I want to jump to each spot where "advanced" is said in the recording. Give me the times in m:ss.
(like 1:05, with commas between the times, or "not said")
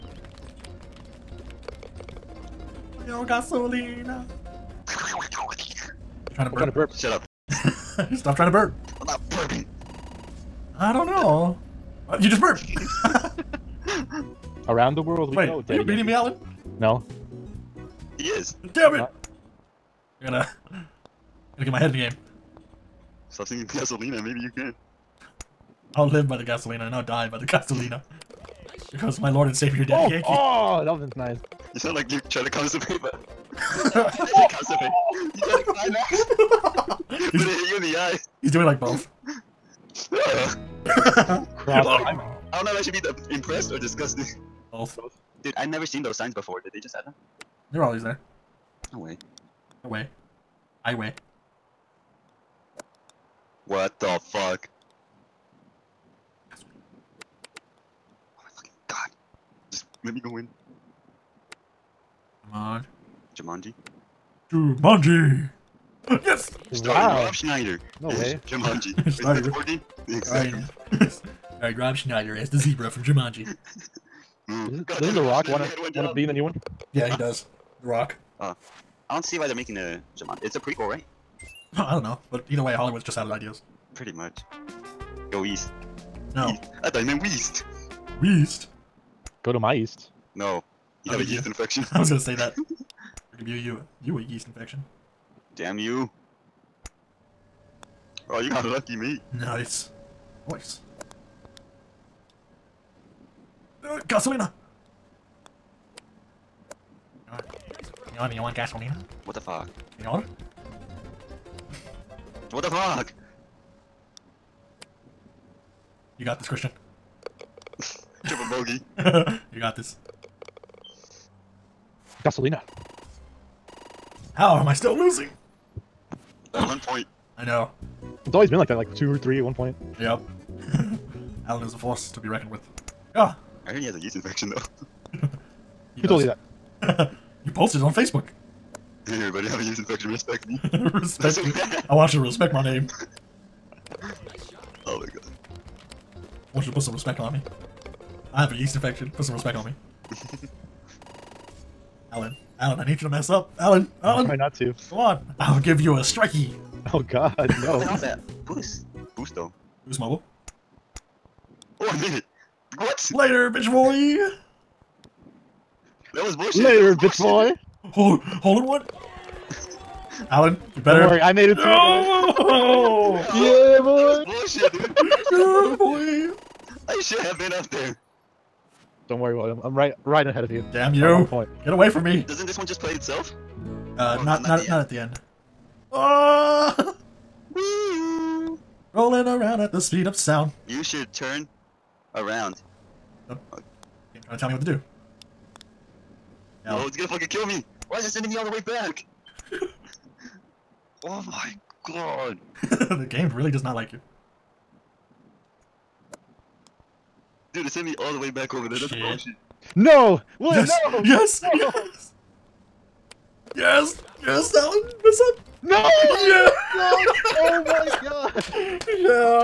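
not said.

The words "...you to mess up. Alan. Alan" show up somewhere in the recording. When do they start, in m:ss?
2:33.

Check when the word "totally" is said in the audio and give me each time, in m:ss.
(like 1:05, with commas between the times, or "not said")
2:16.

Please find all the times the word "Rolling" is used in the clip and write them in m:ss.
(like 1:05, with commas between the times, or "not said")
3:08.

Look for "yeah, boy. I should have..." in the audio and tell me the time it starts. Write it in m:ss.
2:55.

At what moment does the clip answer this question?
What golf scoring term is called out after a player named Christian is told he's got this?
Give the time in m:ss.
1:58.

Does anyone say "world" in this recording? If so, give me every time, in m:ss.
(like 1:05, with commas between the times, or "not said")
0:15.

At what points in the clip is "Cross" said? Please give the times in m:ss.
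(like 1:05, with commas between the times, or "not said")
0:39.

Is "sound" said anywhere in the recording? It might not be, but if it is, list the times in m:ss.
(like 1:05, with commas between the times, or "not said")
0:31, 3:10.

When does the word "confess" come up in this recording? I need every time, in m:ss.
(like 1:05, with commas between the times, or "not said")
not said.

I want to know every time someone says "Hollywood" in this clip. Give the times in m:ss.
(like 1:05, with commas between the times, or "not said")
1:22.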